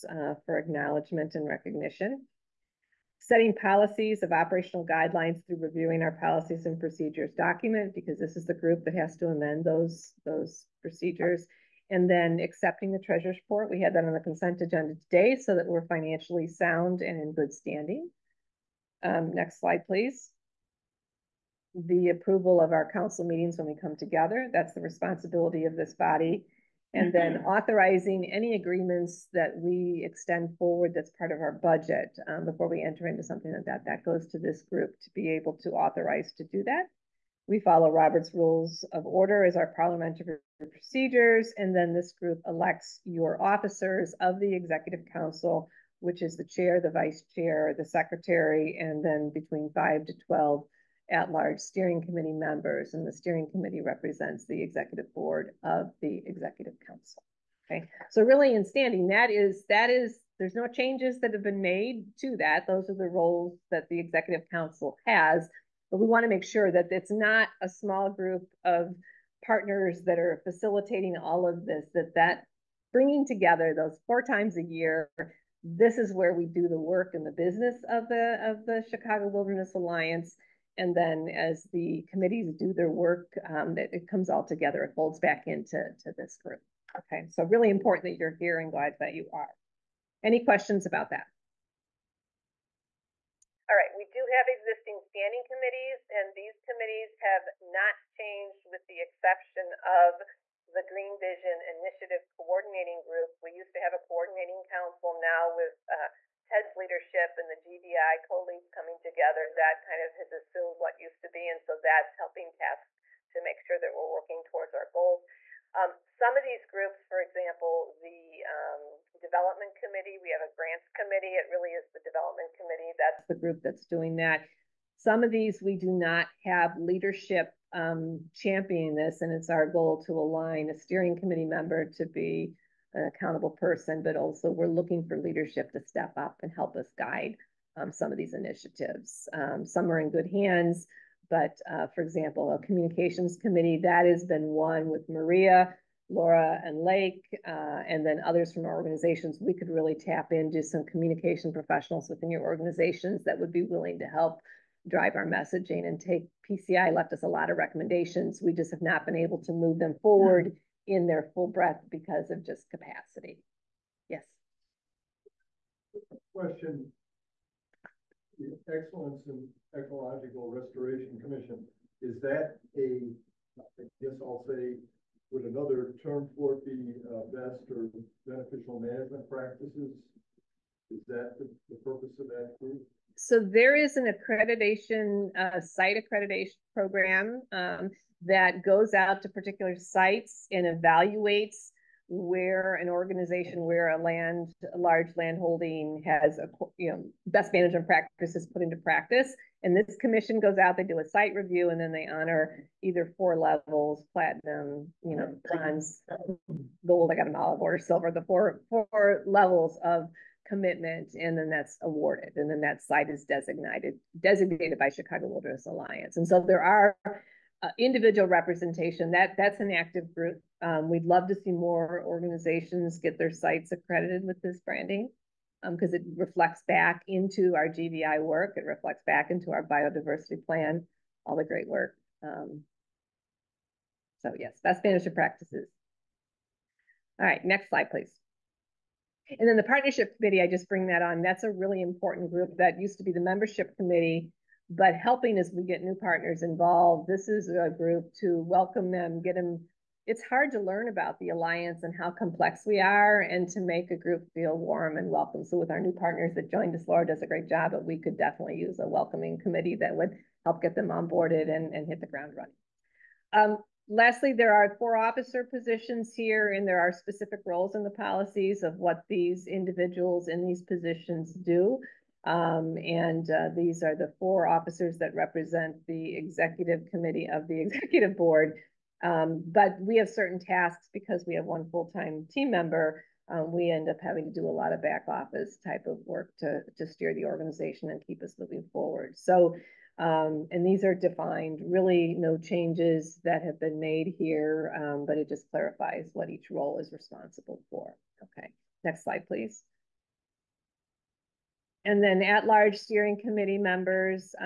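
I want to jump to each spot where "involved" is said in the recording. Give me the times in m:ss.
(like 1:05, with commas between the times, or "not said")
4:06.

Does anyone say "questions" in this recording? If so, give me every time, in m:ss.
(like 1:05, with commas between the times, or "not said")
1:30, 2:46.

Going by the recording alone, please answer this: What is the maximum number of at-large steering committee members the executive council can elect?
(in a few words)
12.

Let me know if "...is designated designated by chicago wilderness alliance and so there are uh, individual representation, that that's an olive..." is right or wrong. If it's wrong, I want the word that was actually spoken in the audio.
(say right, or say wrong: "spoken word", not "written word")
wrong: "active", not "olive".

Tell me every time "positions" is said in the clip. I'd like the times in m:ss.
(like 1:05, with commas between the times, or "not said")
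4:25, 4:30.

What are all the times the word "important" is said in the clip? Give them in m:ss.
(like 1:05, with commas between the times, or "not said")
1:27, 4:01.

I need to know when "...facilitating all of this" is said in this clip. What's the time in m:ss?
1:10.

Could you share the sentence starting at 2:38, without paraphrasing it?
We just have not been able to move them forward in their full breadth because of just capacity.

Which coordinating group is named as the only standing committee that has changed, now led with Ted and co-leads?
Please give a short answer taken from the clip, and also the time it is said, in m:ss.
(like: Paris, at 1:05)
Green Vision Initiative Coordinating Group, at 1:40.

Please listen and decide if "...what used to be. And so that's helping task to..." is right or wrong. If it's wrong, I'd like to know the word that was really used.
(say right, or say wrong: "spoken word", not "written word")
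right.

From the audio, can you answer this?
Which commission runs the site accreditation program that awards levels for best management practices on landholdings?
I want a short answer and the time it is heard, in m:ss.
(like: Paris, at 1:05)
Excellence in Ecological Restoration Commission, at 2:48.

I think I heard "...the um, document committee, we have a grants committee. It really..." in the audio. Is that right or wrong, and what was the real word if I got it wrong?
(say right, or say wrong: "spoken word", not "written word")
wrong: "development", not "document".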